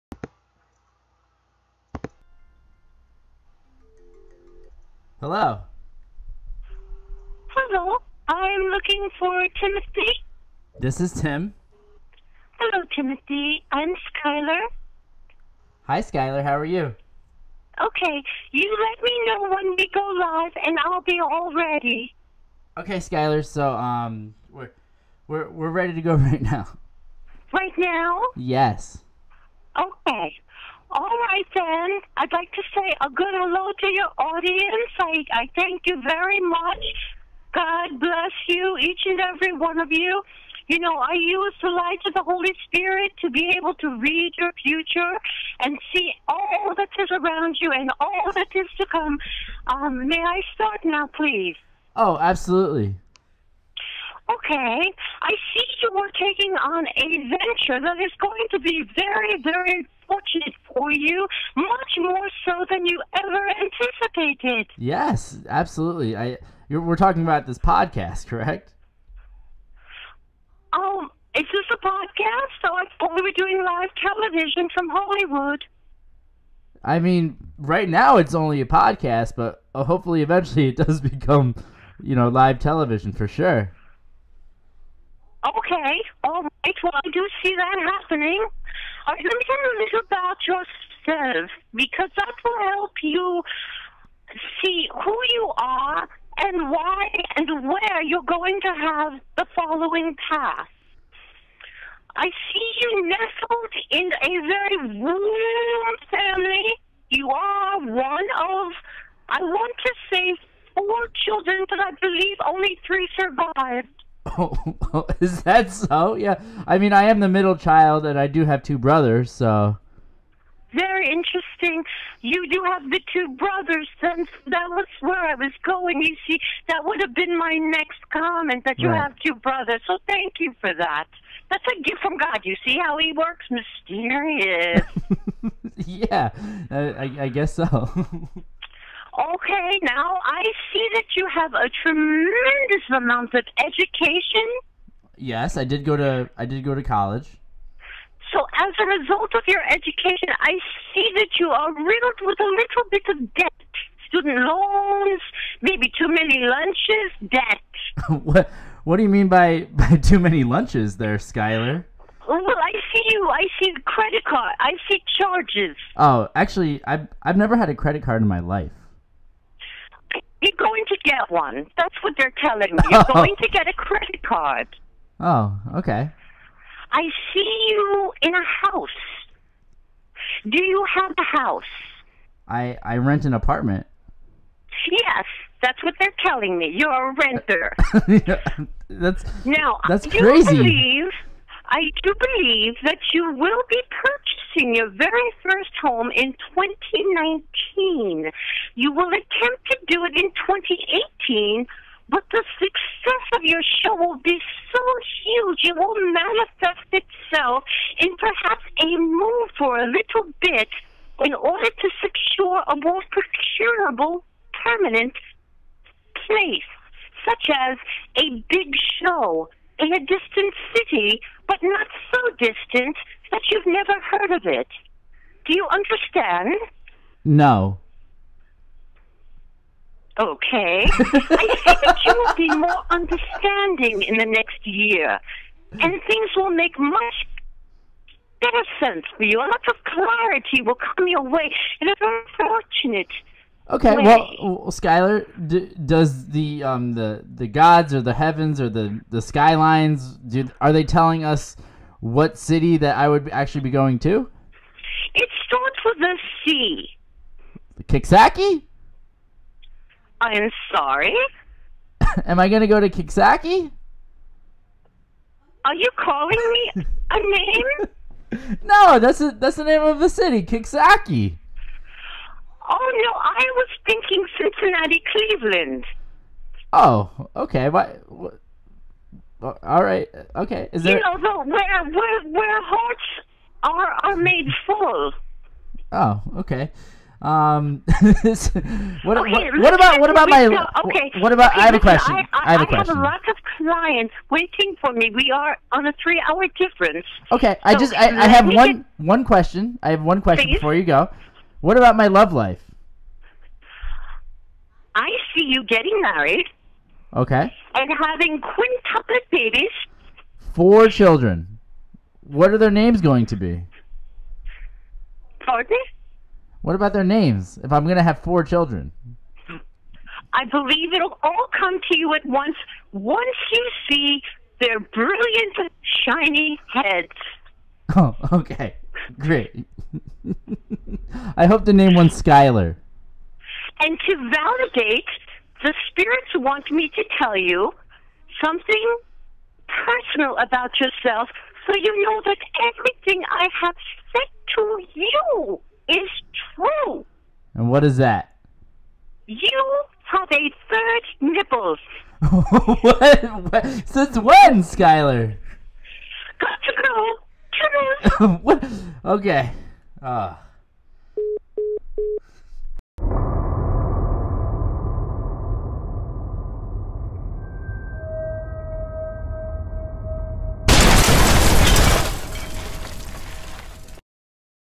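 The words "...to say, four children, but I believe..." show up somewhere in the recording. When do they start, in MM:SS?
01:49.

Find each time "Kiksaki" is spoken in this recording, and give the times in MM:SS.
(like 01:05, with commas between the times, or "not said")
04:17, 04:22, 04:30.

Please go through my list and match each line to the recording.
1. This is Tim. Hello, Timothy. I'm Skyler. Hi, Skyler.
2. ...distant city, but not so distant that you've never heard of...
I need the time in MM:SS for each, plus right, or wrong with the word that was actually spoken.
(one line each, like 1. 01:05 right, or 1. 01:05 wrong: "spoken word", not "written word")
1. 00:10 right
2. 03:39 right.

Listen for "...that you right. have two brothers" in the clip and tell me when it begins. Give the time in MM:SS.
02:08.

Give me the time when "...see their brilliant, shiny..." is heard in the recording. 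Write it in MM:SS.
05:23.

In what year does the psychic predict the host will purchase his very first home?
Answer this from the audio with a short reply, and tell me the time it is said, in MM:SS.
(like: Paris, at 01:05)
2019, at 03:16.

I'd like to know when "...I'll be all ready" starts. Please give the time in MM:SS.
00:20.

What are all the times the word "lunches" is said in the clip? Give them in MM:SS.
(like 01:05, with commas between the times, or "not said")
02:36, 02:40.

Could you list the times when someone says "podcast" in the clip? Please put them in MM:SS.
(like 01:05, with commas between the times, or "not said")
01:07, 01:11, 01:18.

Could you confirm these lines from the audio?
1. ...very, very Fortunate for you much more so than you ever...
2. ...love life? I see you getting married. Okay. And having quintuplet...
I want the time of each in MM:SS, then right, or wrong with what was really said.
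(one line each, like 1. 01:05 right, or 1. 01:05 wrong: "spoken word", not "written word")
1. 00:58 right
2. 05:02 right.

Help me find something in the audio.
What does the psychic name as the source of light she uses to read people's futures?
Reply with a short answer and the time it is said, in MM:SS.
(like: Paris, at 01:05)
The Holy Spirit, at 00:42.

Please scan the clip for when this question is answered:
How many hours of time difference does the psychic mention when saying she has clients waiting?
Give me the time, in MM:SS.
04:56.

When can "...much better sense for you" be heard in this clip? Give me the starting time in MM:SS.
03:56.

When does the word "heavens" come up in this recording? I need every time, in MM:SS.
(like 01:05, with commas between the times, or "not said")
04:08.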